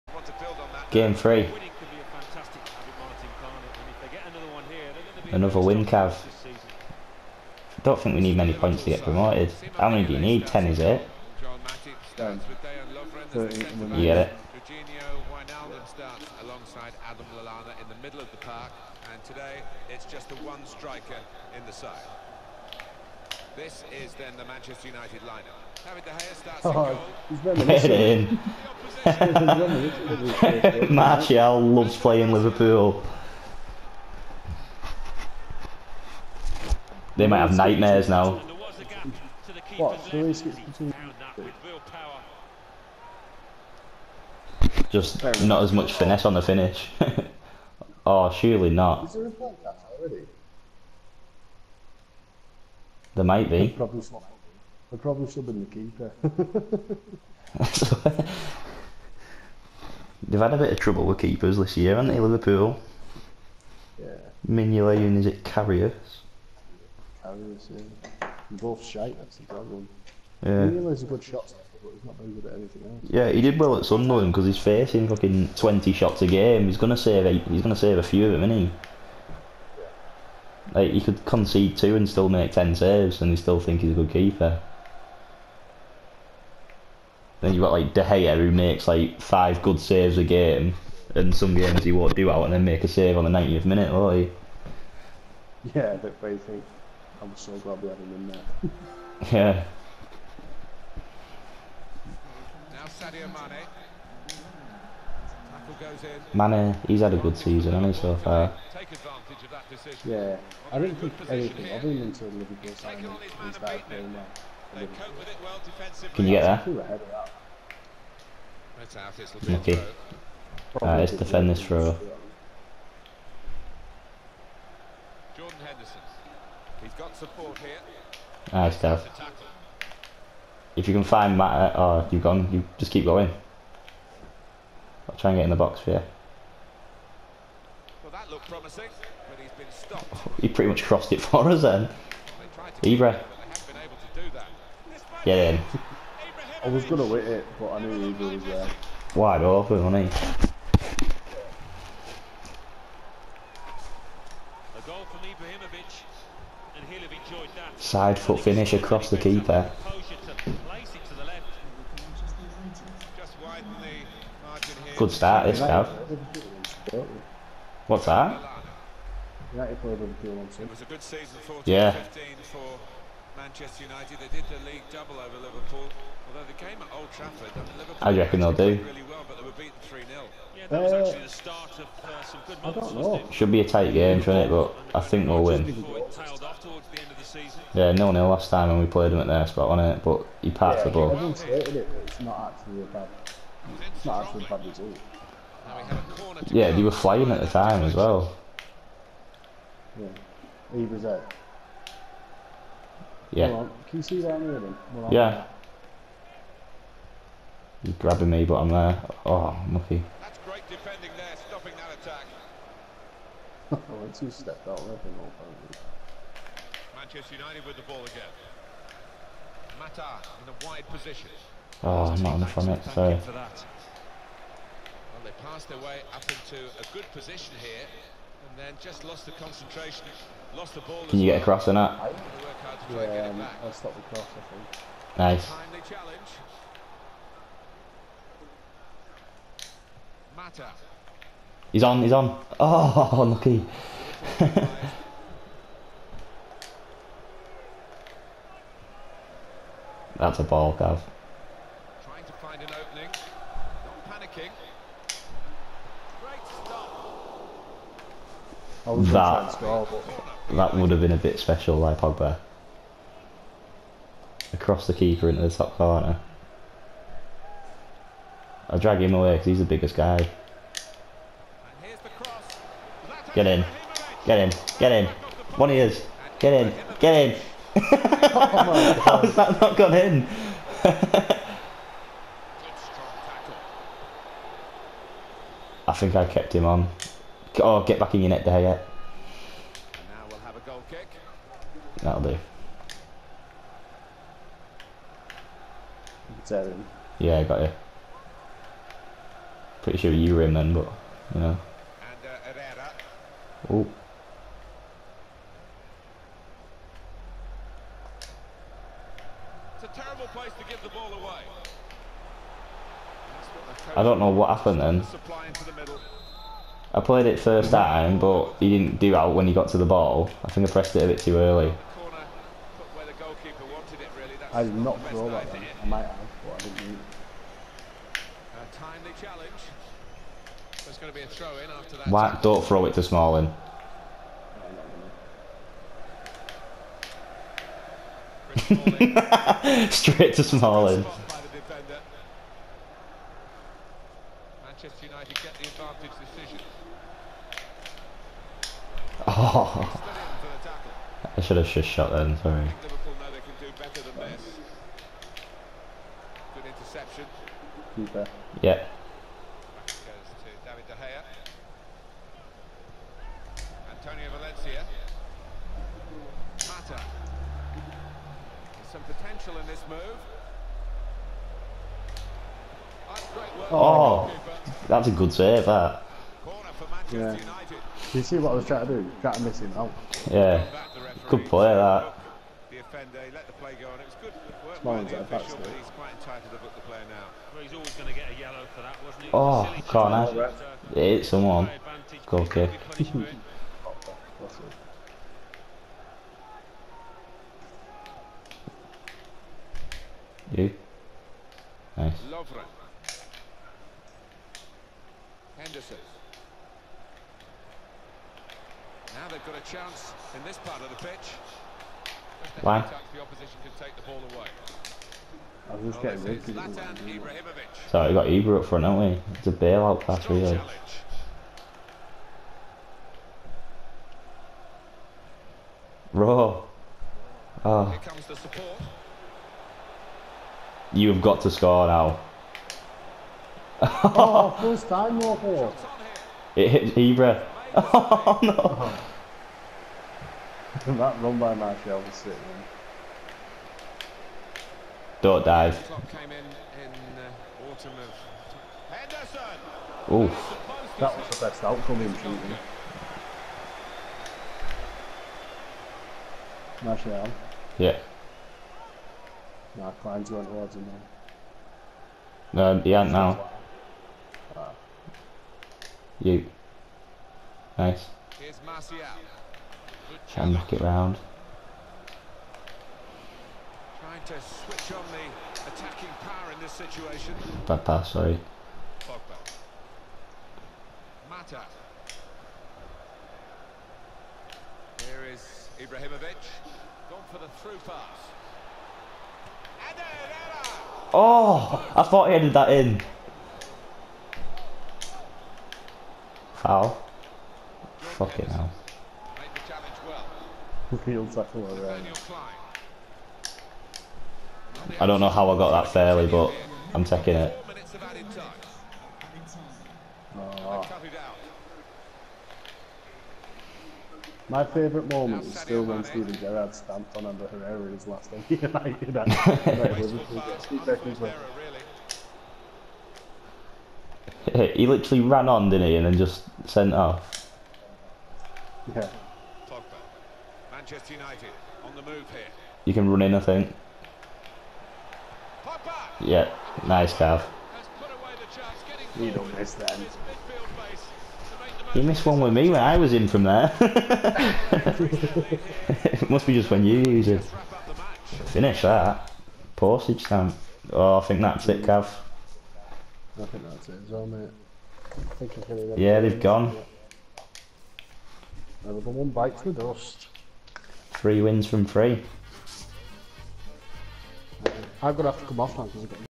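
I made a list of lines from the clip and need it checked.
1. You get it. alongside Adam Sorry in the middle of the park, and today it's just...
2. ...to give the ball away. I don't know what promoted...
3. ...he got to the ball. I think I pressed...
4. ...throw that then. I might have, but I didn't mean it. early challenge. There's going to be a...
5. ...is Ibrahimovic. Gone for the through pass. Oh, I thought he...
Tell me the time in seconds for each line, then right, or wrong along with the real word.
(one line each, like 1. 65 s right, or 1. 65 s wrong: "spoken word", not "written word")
1. 13 s wrong: "Lallana", not "Sorry"
2. 310 s wrong: "happened", not "promoted"
3. 319 s right
4. 325 s wrong: "timely", not "early"
5. 485 s right.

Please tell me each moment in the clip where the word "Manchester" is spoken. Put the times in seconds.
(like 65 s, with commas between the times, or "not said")
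24 s, 173 s, 216 s, 530 s.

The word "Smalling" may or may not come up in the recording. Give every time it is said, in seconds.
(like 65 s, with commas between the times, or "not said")
333 s, 340 s.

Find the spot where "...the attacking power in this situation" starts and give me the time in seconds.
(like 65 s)
475 s.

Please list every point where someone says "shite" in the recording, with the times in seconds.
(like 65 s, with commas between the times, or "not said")
68 s.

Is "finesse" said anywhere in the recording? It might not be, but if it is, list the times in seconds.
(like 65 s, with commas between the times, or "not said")
45 s.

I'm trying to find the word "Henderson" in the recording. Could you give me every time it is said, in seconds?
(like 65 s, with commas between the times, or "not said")
125 s, 405 s.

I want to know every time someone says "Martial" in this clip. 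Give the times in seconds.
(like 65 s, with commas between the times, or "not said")
30 s, 441 s, 456 s.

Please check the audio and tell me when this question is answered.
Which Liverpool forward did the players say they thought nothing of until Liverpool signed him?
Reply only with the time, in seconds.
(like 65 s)
102 s.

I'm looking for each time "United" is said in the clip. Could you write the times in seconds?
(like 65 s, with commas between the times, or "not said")
24 s, 173 s, 217 s, 518 s, 531 s.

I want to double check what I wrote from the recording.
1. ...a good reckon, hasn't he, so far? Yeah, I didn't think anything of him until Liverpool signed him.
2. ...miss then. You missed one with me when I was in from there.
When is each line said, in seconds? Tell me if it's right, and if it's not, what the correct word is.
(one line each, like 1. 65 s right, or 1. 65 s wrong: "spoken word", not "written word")
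1. 107 s wrong: "season", not "reckon"
2. 539 s right.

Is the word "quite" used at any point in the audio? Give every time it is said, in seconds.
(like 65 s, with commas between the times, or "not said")
385 s.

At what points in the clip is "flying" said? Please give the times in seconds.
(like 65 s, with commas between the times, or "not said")
196 s.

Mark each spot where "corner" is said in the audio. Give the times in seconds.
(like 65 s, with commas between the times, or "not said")
265 s, 389 s.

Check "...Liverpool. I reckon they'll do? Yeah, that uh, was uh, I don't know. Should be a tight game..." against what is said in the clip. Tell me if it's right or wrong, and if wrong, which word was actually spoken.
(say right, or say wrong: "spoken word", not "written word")
right.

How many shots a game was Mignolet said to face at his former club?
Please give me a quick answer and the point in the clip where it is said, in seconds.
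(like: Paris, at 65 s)
20, at 75 s.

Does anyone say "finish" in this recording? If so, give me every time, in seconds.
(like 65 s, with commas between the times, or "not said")
46 s, 158 s, 548 s.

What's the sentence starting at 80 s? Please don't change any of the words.
Like he could concede two and still make ten saves, and you still think he's a good keeper.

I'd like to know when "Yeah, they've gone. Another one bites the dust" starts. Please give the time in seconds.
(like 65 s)
556 s.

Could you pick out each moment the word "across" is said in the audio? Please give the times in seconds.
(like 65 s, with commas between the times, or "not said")
158 s, 231 s, 264 s.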